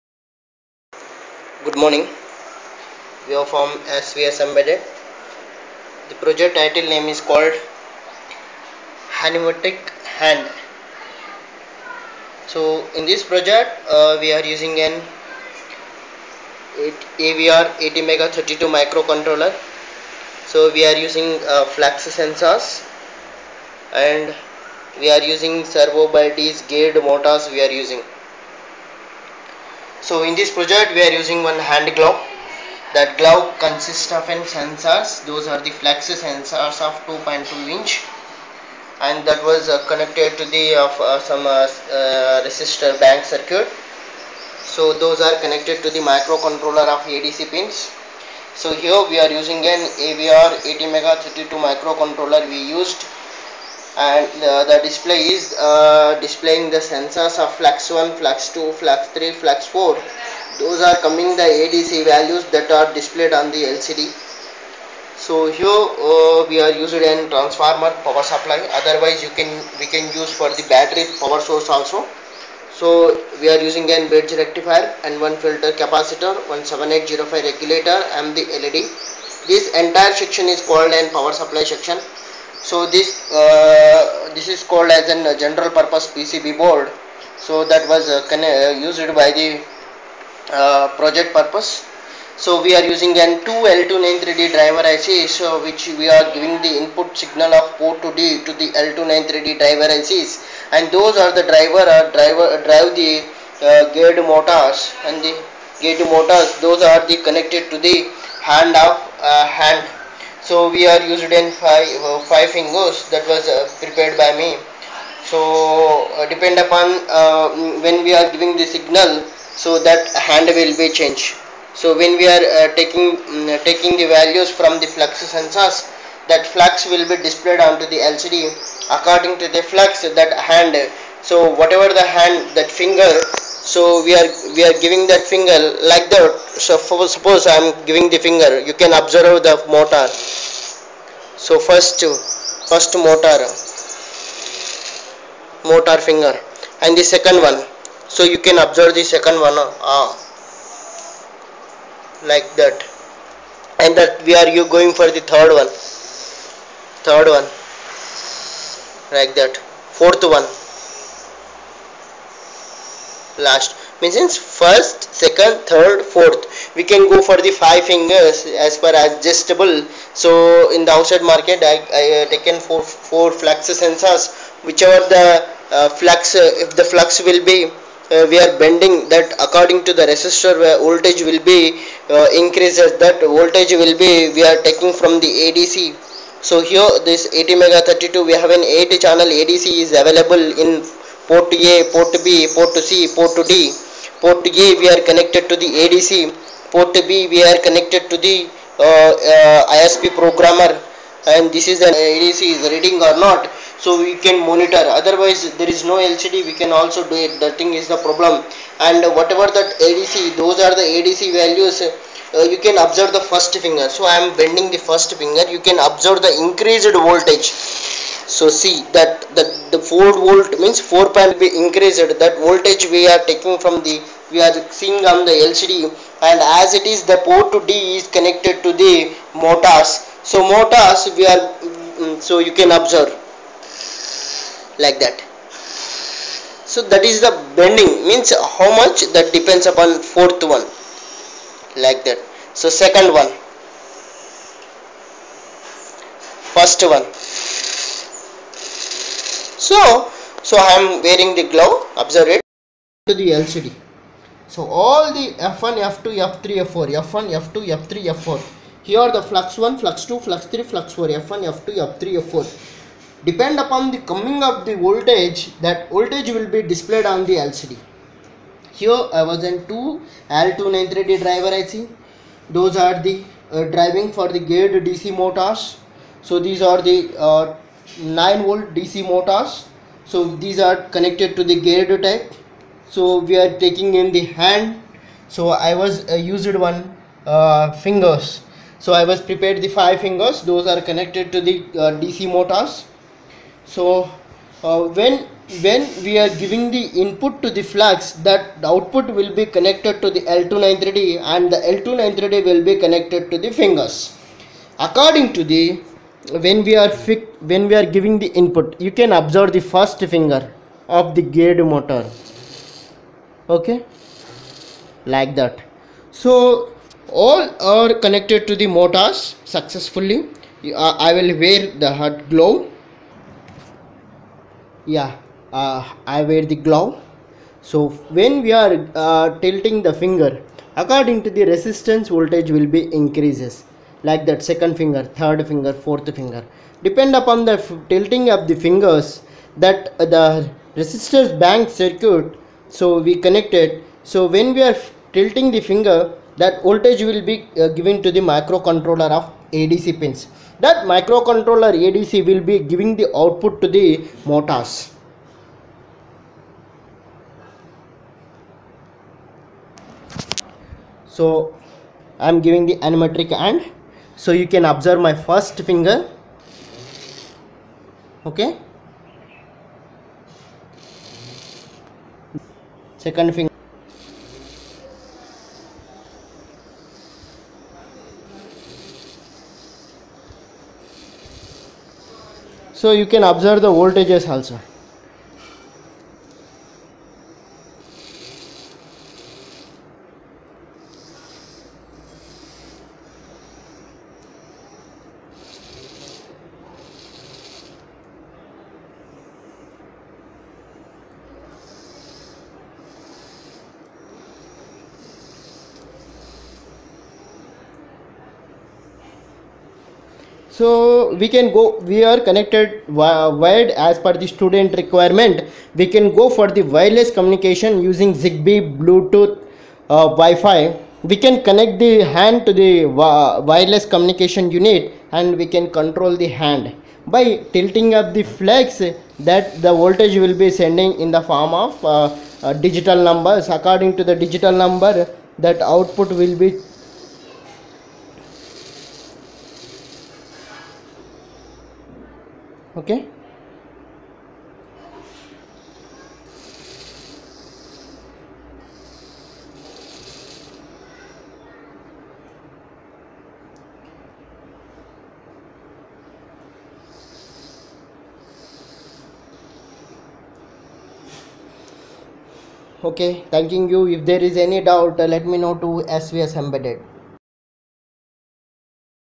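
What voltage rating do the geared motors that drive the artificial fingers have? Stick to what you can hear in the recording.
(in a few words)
9 volt.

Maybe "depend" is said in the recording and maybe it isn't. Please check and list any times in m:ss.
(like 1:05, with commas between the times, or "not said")
1:56, 3:59, 4:23, 5:36.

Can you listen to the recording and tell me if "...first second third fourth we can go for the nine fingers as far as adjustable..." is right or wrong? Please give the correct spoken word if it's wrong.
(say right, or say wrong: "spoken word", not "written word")
wrong: "five", not "nine".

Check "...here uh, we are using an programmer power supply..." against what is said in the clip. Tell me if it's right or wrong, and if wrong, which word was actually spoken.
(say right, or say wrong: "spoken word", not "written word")
wrong: "transformer", not "programmer".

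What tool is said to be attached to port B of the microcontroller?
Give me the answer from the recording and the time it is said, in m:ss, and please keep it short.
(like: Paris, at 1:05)
ISP programmer, at 3:19.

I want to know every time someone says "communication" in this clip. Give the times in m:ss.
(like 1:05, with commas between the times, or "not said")
6:57, 7:03.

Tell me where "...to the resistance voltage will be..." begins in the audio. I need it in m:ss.
5:31.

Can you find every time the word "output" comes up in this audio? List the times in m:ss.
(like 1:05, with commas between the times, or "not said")
4:58, 5:53, 7:15.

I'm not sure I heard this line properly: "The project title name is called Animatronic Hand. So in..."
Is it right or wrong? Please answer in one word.
right.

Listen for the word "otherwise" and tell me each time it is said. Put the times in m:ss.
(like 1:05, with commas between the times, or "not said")
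1:08, 3:24.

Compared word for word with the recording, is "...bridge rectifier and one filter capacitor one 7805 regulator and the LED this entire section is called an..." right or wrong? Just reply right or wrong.
right.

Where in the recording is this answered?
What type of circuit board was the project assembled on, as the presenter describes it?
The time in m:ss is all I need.
1:25.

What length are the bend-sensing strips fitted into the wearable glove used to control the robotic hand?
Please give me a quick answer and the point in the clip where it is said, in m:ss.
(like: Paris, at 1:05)
2.2 inch, at 0:37.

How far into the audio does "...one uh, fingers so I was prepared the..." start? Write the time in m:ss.
4:46.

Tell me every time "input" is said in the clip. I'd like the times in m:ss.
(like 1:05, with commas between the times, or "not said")
1:36, 4:57, 5:08.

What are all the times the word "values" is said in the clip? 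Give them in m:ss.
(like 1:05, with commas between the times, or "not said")
1:02, 2:04, 3:31.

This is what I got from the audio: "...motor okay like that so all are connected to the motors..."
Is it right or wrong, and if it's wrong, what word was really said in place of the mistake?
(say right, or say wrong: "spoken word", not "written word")
right.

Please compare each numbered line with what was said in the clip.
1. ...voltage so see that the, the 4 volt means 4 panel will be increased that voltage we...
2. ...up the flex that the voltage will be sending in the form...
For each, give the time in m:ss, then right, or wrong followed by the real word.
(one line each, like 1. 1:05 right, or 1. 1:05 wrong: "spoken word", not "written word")
1. 3:36 right
2. 7:07 right.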